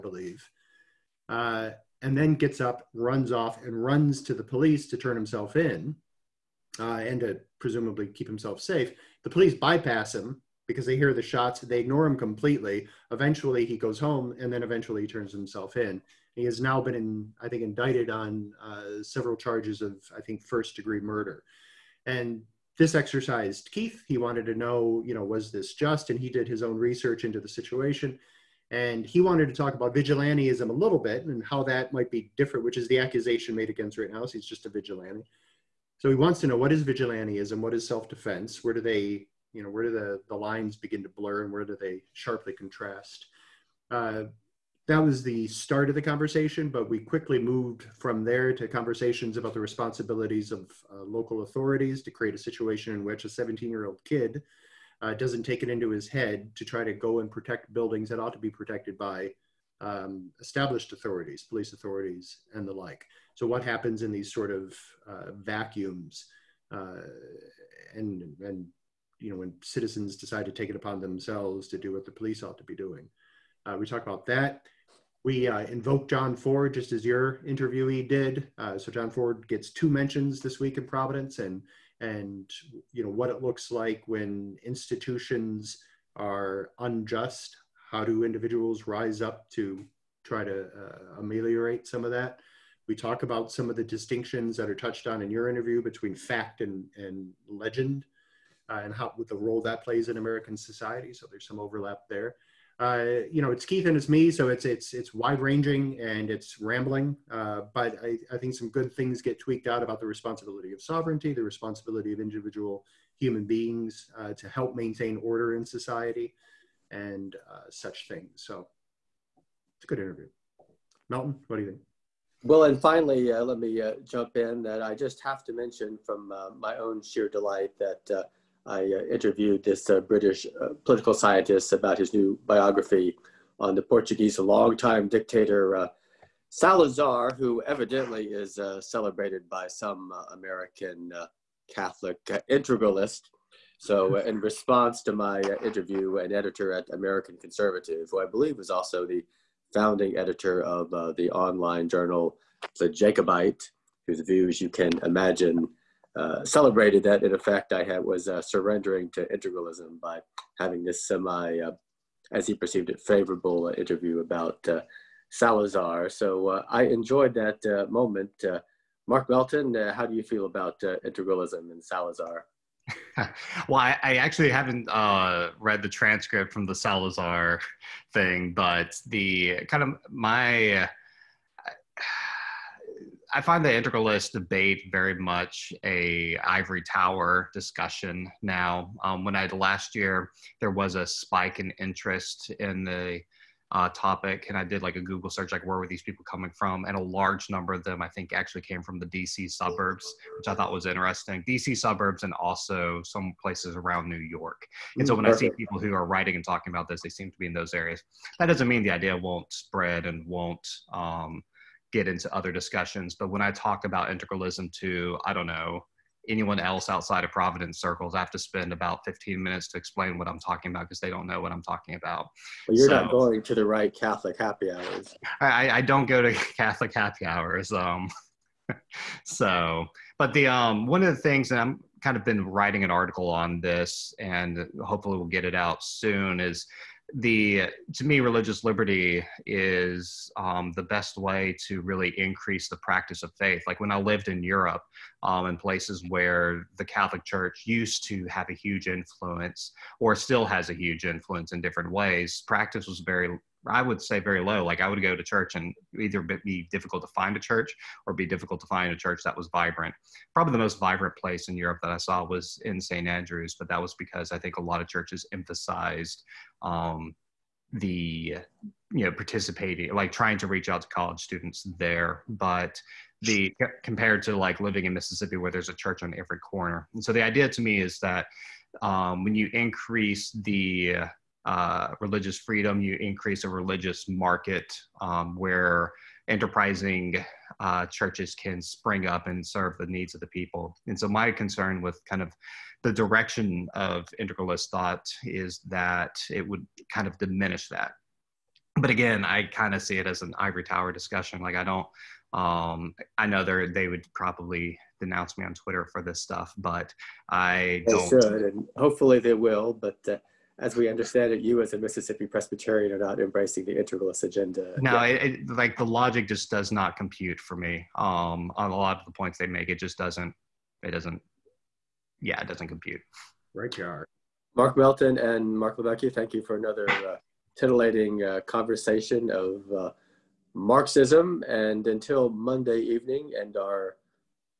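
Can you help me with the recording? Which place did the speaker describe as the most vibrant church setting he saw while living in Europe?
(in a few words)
St. Andrews.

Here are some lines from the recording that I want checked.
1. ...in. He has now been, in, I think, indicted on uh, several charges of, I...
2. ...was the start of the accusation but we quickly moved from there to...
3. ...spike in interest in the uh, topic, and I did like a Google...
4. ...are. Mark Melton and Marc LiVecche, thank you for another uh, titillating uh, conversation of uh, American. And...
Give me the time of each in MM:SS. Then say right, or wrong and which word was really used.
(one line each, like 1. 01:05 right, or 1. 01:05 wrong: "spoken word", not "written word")
1. 00:15 right
2. 00:44 wrong: "conversation", not "accusation"
3. 03:11 right
4. 05:23 wrong: "Marksism", not "American".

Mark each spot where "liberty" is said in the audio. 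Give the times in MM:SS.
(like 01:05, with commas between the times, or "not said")
03:58.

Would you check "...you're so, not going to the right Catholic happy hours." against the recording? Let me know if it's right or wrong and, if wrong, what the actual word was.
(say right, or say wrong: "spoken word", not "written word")
right.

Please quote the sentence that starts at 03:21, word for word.
DC suburbs and also some places around New York.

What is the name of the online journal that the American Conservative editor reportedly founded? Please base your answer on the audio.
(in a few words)
The Jacobite.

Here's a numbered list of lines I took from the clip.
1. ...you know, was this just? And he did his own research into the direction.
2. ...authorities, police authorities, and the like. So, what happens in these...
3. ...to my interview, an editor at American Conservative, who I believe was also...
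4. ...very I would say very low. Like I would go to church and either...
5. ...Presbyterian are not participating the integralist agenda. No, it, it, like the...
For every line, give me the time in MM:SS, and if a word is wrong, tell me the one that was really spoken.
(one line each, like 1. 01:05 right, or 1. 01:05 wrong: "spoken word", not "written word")
1. 00:25 wrong: "situation", not "direction"
2. 01:00 right
3. 02:25 right
4. 04:12 right
5. 05:12 wrong: "embracing", not "participating".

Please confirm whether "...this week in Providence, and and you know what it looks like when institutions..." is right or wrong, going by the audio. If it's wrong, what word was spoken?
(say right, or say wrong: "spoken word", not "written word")
right.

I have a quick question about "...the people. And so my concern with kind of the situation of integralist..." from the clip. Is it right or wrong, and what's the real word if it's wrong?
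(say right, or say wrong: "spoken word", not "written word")
wrong: "direction", not "situation".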